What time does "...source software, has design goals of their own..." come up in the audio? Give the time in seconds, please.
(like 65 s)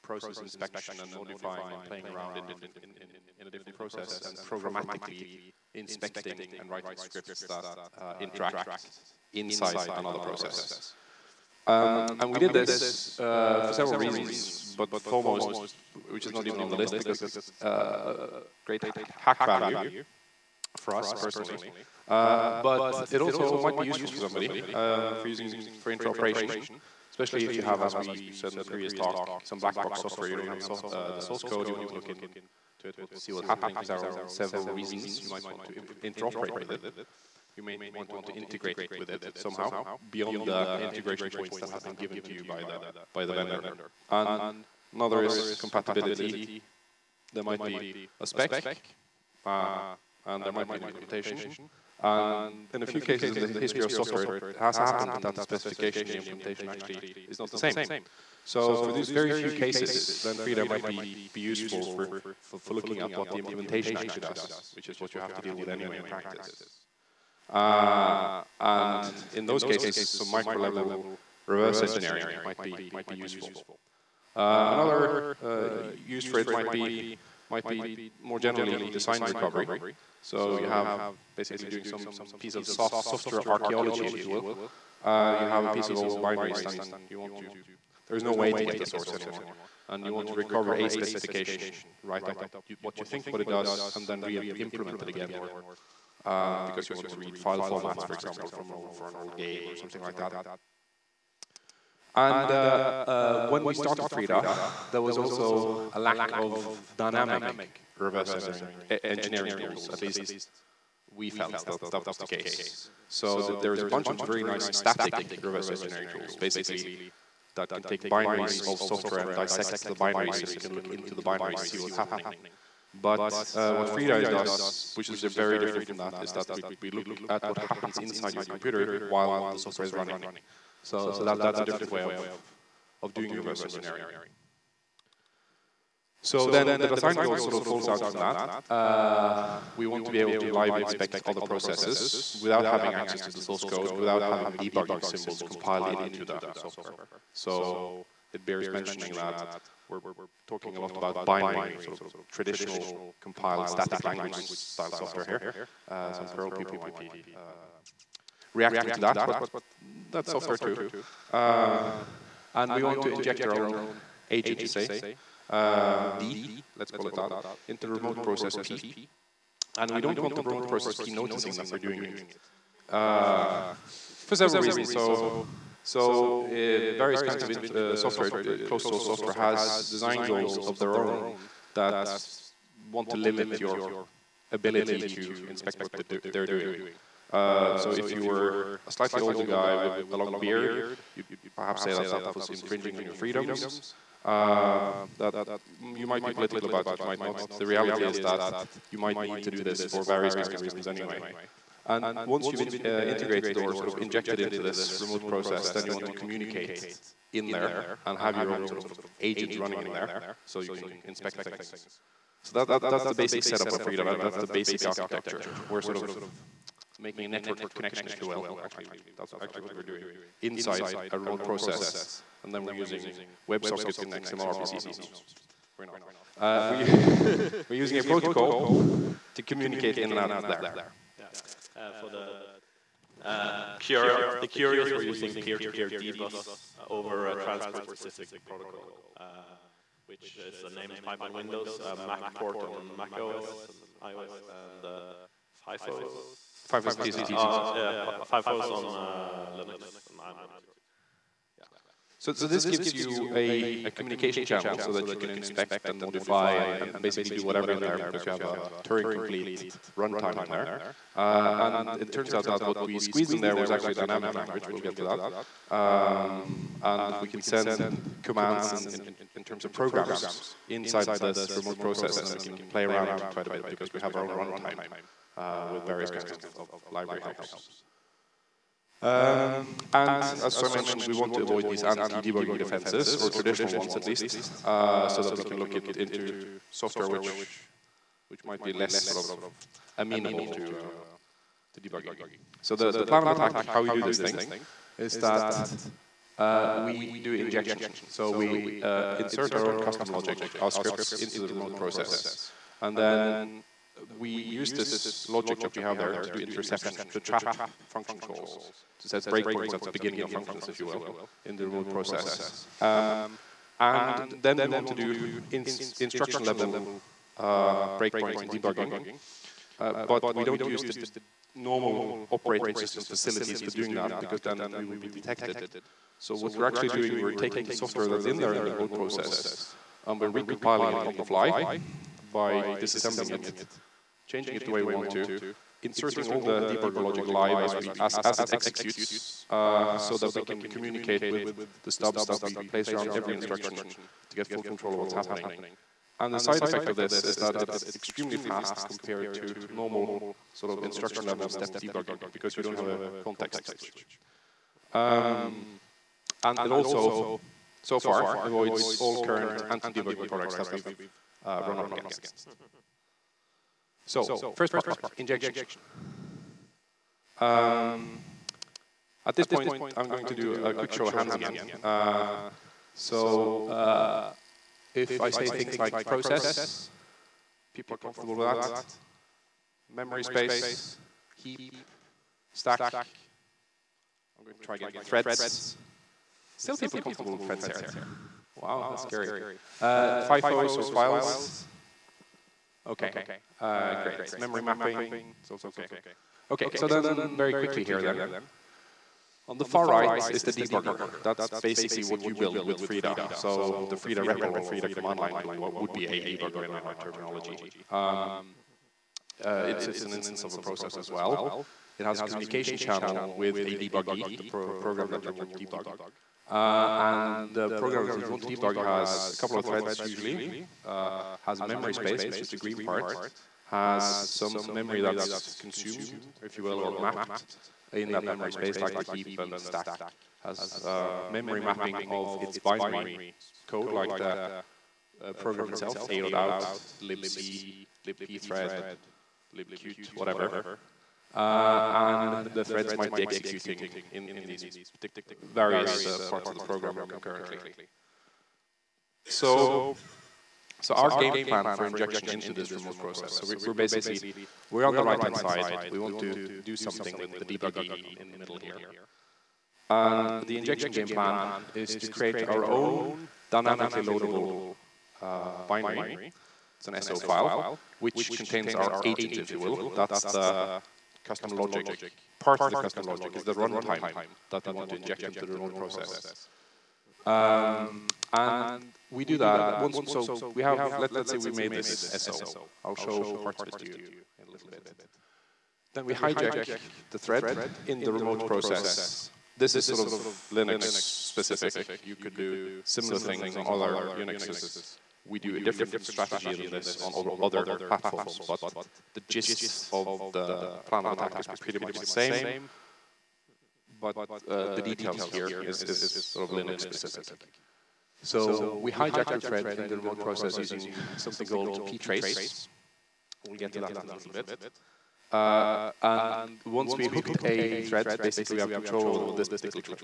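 178 s.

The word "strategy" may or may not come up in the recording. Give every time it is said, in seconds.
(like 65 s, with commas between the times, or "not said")
496 s.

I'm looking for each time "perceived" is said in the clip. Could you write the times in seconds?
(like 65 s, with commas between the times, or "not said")
not said.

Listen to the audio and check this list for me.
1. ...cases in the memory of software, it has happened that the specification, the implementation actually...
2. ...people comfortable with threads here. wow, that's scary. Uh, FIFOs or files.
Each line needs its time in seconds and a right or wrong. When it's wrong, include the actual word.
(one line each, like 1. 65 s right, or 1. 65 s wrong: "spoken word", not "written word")
1. 53 s wrong: "history", not "memory"
2. 386 s right.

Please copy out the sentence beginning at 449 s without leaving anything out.
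So, so our game plan for injection into this remote process, so we, we're basically we're on the right-hand side.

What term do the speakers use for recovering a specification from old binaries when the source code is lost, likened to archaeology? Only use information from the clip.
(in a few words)
design recovery.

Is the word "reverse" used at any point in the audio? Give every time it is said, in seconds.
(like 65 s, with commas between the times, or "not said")
71 s, 107 s, 115 s, 133 s.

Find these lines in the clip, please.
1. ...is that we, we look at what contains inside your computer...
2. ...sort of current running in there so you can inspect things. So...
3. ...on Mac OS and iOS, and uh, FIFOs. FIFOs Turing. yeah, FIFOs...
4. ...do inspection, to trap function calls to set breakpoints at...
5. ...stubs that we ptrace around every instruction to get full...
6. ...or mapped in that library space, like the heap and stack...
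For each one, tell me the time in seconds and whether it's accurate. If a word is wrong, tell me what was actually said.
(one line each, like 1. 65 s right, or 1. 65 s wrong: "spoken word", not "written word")
1. 126 s wrong: "happens", not "contains"
2. 208 s wrong: "agent", not "current"
3. 242 s wrong: "TCPs", not "Turing"
4. 306 s wrong: "interception", not "inspection"
5. 341 s wrong: "place", not "ptrace"
6. 426 s wrong: "memory", not "library".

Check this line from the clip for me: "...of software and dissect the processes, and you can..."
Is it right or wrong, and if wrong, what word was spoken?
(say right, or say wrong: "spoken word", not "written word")
wrong: "binaries", not "processes".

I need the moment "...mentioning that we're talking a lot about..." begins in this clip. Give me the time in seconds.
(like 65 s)
148 s.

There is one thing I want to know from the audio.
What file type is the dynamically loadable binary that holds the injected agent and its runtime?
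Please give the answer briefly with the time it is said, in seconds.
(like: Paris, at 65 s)
SO file, at 467 s.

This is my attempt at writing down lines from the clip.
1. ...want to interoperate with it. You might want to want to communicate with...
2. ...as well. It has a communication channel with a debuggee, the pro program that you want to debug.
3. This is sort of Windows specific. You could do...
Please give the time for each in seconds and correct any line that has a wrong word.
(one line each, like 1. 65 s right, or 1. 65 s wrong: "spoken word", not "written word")
1. 35 s wrong: "integrate", not "communicate"
2. 410 s right
3. 489 s wrong: "Linux", not "Windows".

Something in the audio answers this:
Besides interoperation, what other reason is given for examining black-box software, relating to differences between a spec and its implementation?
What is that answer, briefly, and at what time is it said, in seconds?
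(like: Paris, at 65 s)
compatibility, at 45 s.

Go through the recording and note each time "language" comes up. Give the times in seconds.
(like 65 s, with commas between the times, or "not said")
154 s, 264 s.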